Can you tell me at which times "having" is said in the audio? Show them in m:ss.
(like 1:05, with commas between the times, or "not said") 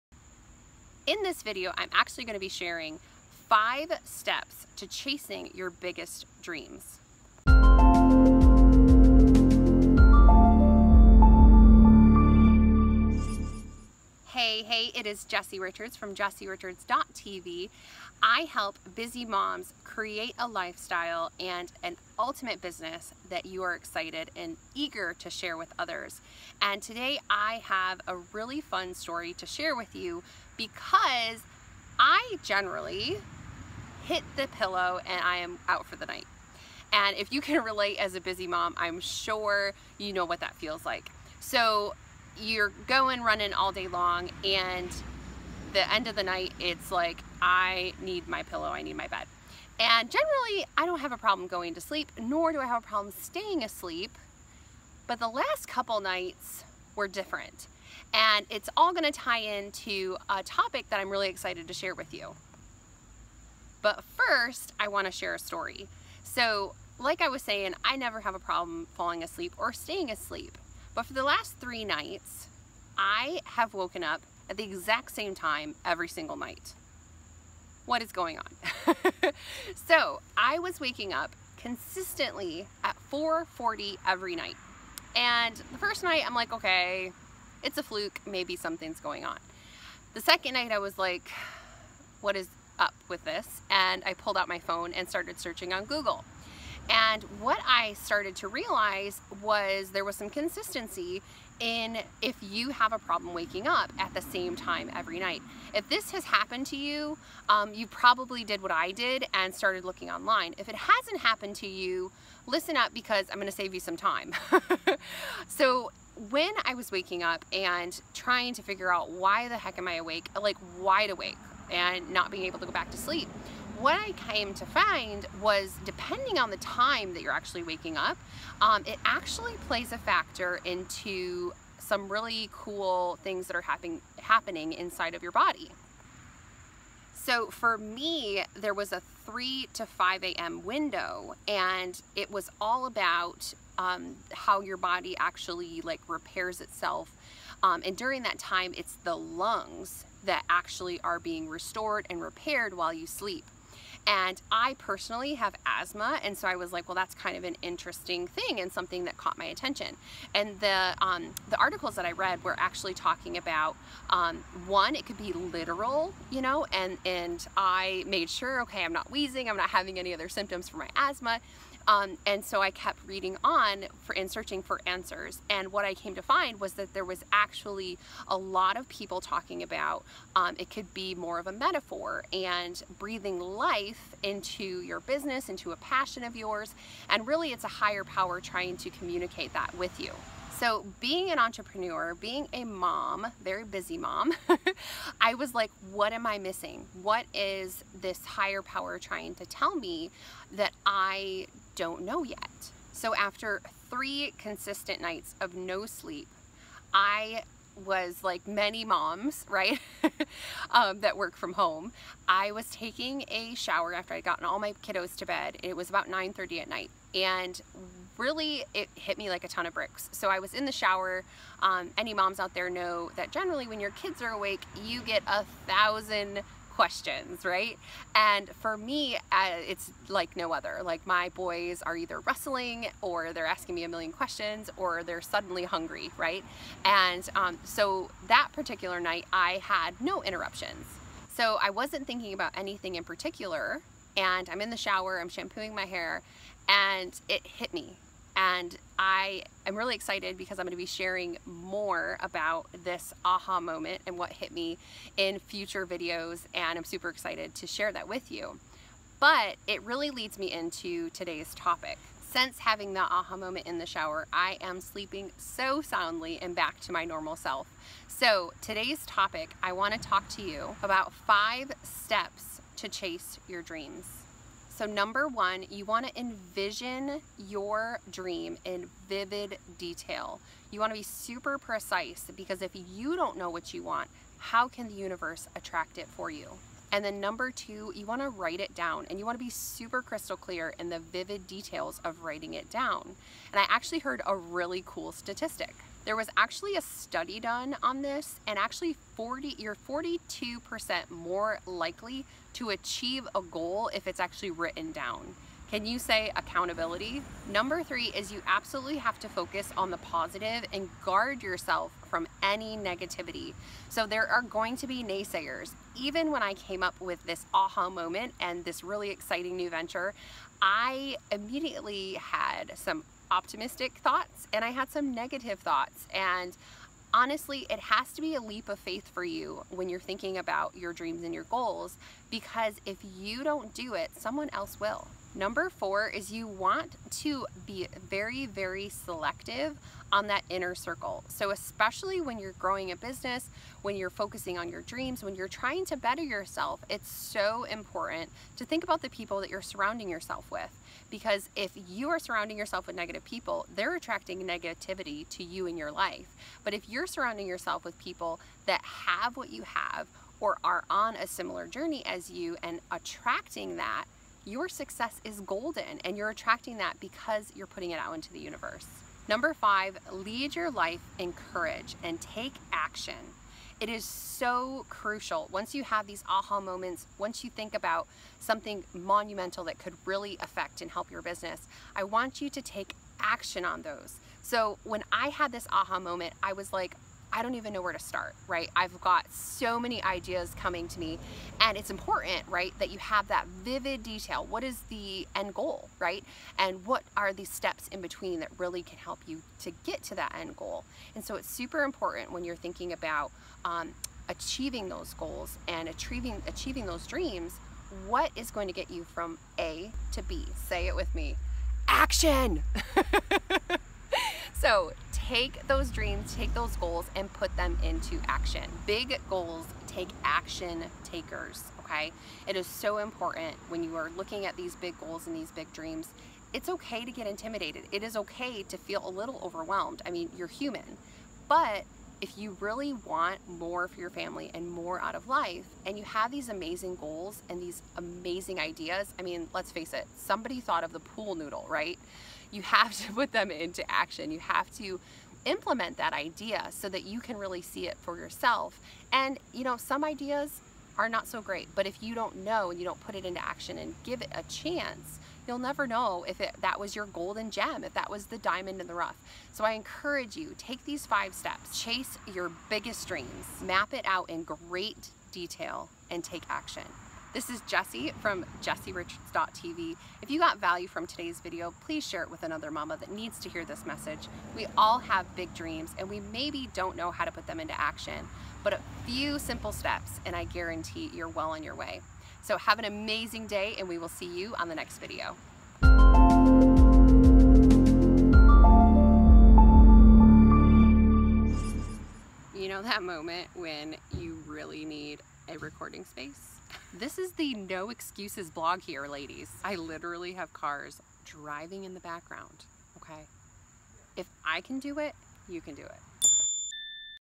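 2:49, 4:22.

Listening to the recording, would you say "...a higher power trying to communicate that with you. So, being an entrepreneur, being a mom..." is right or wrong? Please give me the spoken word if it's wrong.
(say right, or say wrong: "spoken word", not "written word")
right.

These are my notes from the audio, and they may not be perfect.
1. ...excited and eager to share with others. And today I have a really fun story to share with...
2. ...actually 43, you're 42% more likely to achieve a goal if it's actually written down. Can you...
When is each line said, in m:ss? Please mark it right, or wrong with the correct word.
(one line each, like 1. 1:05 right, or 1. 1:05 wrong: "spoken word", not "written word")
1. 0:23 right
2. 4:58 wrong: "40", not "43".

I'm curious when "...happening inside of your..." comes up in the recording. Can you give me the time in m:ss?
2:14.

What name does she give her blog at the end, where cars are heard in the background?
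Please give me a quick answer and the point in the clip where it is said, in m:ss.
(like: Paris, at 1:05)
The no excuses blog, at 8:17.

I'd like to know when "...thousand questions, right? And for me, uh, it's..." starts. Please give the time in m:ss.
3:45.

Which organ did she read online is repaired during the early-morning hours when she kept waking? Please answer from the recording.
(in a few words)
The lungs.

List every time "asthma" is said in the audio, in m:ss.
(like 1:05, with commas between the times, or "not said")
2:35, 2:50.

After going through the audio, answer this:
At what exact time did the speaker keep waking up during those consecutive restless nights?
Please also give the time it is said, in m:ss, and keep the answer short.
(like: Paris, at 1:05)
4:40, at 1:23.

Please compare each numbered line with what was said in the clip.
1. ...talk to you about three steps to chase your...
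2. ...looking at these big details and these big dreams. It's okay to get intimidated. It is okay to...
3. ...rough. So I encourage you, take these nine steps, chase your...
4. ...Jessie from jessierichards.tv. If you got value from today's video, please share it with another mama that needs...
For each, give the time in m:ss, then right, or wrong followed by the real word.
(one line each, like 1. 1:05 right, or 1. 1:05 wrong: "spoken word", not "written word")
1. 4:29 wrong: "five", not "three"
2. 7:04 wrong: "goals", not "details"
3. 7:38 wrong: "five", not "nine"
4. 7:47 right.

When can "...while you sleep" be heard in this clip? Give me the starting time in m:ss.
2:32.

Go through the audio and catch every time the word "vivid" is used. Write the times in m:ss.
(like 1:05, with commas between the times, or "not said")
4:39, 4:50, 6:33.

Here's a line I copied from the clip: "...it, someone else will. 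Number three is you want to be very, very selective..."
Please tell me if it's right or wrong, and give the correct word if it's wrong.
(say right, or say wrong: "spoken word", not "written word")
wrong: "four", not "three".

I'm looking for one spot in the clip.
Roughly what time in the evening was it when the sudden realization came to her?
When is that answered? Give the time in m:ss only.
3:36.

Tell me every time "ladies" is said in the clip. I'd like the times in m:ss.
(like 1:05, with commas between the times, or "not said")
8:19.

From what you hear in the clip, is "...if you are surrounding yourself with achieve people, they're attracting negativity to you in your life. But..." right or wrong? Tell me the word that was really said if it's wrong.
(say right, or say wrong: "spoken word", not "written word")
wrong: "negative", not "achieve".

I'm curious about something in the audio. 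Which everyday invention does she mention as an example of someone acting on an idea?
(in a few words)
The pool noodle.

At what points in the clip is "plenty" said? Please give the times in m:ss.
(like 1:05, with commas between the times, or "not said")
not said.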